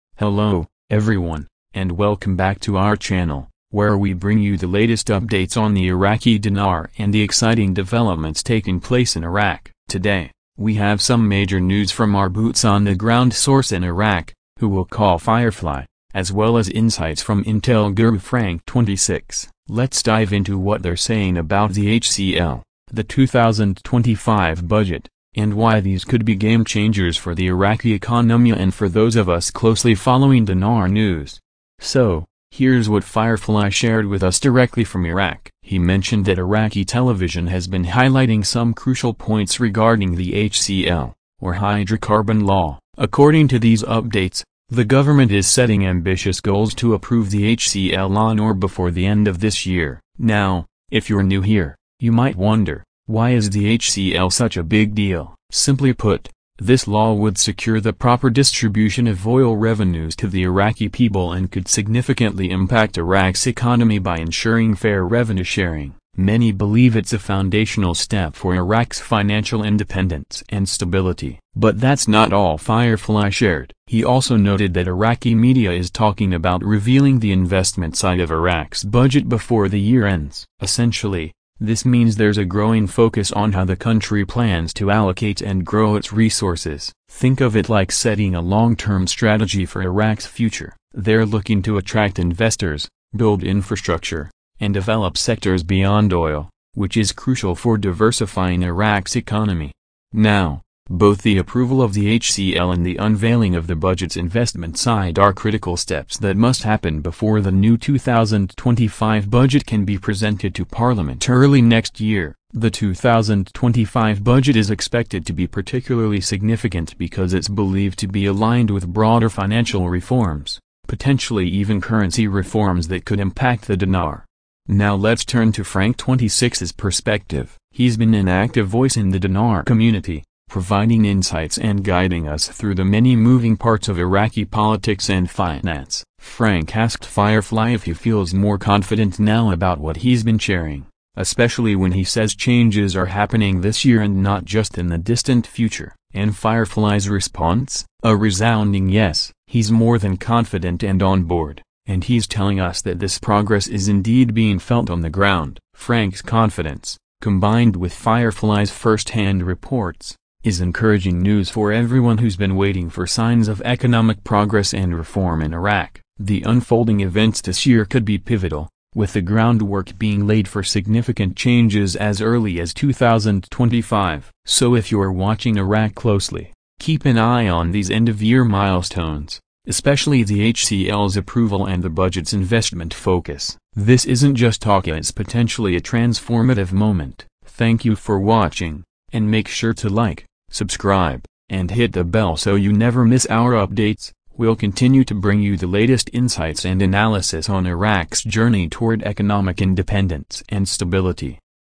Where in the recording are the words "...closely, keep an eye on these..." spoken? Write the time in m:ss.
2:55.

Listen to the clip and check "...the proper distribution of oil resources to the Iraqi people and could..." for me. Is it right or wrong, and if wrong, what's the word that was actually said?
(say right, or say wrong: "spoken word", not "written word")
wrong: "revenues", not "resources".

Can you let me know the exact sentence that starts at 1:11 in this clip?
But that's not all Firefly shared.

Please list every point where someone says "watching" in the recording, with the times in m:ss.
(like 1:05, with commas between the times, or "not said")
2:55, 3:08.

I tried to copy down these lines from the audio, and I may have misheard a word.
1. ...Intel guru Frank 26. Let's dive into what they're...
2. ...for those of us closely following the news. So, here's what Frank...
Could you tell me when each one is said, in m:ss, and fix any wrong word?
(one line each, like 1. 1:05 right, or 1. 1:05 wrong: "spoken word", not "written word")
1. 0:17 right
2. 0:28 wrong: "Firefly", not "Frank".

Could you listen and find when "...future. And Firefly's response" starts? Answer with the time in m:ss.
2:25.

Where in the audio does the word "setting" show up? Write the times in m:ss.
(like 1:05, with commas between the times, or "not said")
0:45, 1:27.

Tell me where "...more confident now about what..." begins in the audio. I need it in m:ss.
2:18.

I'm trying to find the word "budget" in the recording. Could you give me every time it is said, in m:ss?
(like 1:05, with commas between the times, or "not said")
0:24, 1:18, 1:43, 1:49, 1:54, 3:01.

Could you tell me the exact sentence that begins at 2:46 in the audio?
The unfolding events this year could be pivotal, with the groundwork being laid for significant changes as early as 2025.